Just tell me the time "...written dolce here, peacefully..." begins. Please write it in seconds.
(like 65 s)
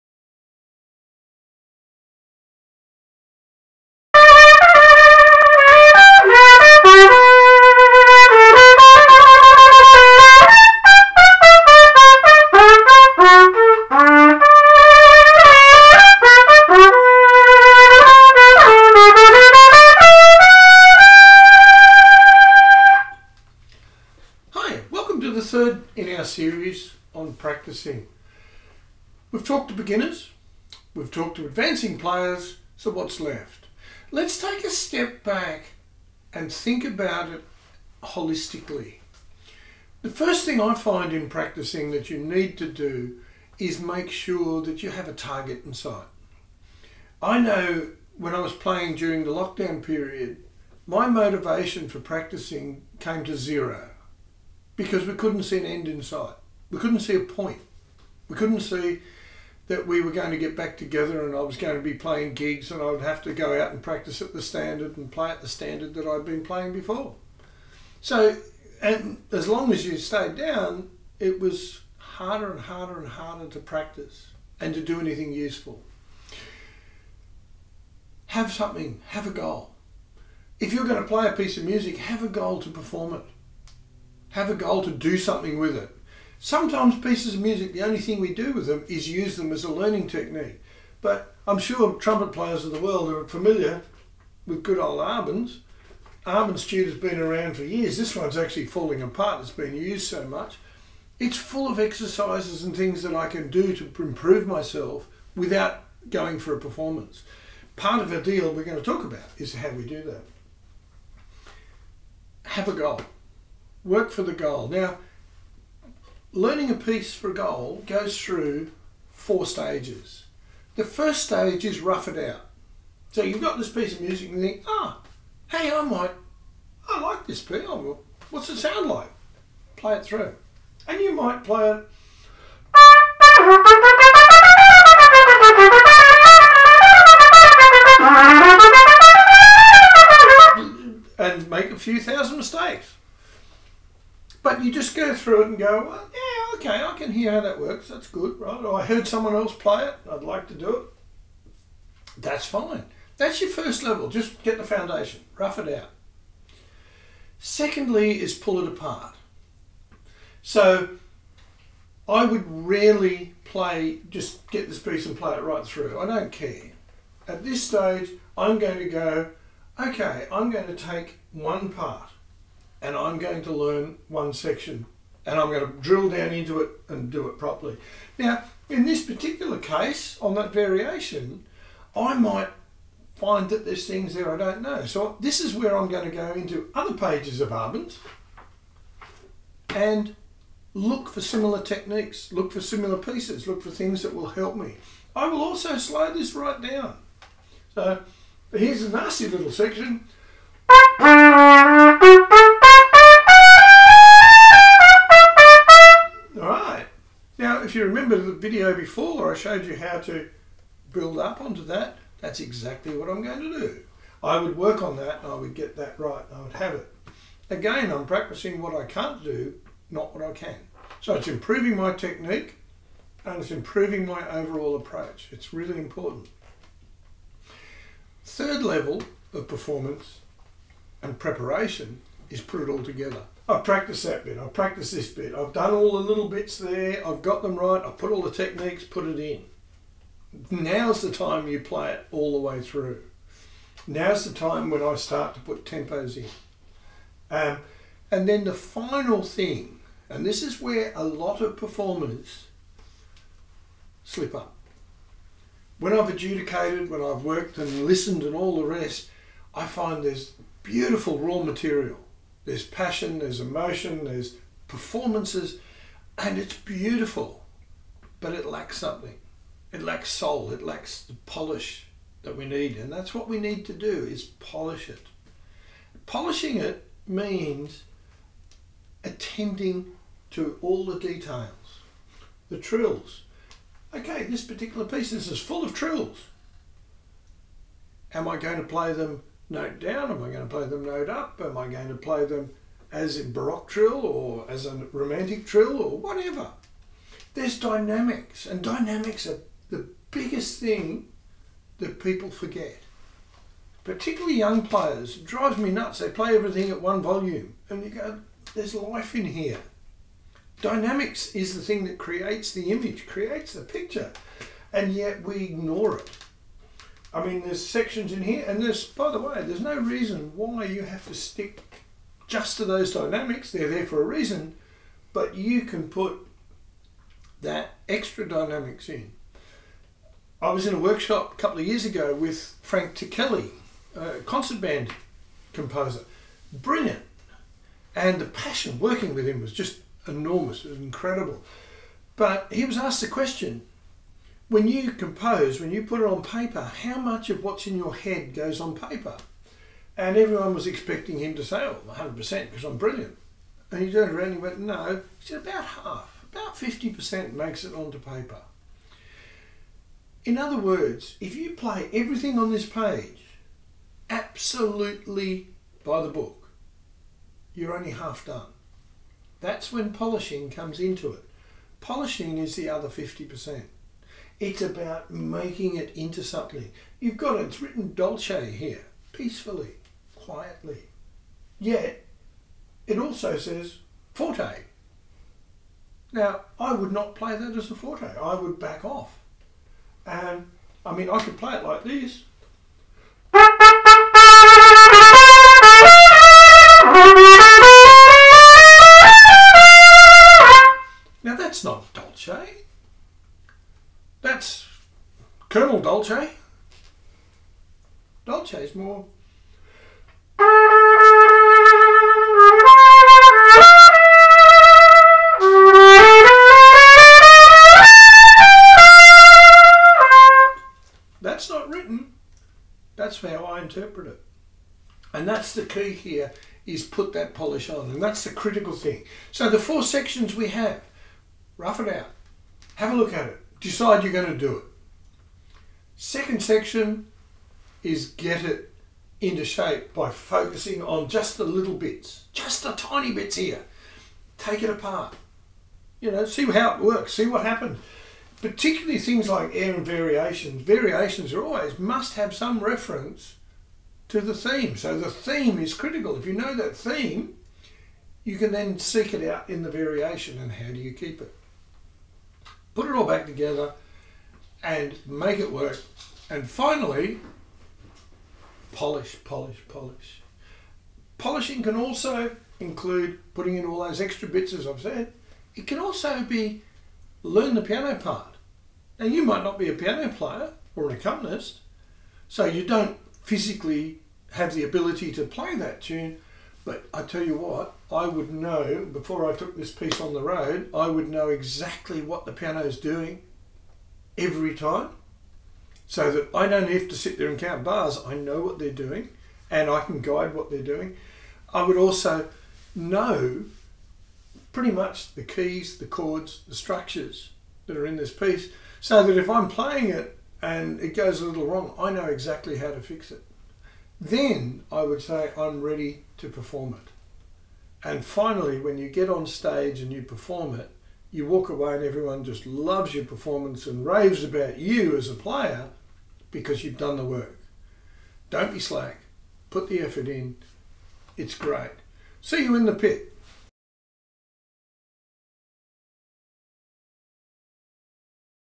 377 s.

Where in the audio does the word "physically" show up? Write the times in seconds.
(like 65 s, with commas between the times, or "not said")
483 s.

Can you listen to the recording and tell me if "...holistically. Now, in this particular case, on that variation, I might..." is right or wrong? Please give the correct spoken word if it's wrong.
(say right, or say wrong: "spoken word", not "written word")
wrong: "properly", not "holistically".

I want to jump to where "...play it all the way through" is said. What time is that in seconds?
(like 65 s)
241 s.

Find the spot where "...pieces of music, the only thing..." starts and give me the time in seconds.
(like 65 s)
86 s.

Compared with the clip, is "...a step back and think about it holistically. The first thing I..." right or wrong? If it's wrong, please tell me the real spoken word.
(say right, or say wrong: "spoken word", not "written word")
right.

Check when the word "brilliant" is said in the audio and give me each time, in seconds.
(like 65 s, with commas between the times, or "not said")
336 s, 352 s.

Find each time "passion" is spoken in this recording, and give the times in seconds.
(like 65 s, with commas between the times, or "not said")
262 s, 338 s.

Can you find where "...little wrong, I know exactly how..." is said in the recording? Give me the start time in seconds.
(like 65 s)
511 s.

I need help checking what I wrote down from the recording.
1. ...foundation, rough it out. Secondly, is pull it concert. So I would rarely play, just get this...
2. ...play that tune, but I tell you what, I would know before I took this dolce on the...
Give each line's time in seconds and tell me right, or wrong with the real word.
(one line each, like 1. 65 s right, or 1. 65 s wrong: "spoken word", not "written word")
1. 154 s wrong: "apart", not "concert"
2. 485 s wrong: "piece", not "dolce".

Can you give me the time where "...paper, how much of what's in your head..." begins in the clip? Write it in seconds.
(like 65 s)
346 s.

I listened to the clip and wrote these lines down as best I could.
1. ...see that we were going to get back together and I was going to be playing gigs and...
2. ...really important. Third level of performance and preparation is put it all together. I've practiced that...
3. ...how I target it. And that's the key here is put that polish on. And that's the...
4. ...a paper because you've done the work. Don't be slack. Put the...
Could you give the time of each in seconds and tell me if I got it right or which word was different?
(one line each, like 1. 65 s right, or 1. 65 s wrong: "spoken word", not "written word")
1. 58 s right
2. 225 s right
3. 423 s wrong: "interpret", not "target"
4. 525 s wrong: "player", not "paper".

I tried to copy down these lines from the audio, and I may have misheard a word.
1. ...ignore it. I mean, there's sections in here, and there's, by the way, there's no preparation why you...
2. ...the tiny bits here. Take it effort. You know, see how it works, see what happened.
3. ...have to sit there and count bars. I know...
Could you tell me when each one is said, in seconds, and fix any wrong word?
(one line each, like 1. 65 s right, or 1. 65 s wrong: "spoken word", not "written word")
1. 315 s wrong: "reason", not "preparation"
2. 442 s wrong: "apart", not "effort"
3. 496 s right.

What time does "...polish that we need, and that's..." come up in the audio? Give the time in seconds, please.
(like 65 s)
271 s.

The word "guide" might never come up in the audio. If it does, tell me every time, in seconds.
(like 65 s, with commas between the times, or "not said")
500 s.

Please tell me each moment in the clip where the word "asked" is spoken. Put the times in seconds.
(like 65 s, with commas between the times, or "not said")
342 s.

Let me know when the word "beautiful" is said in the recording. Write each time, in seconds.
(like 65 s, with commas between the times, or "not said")
260 s, 266 s.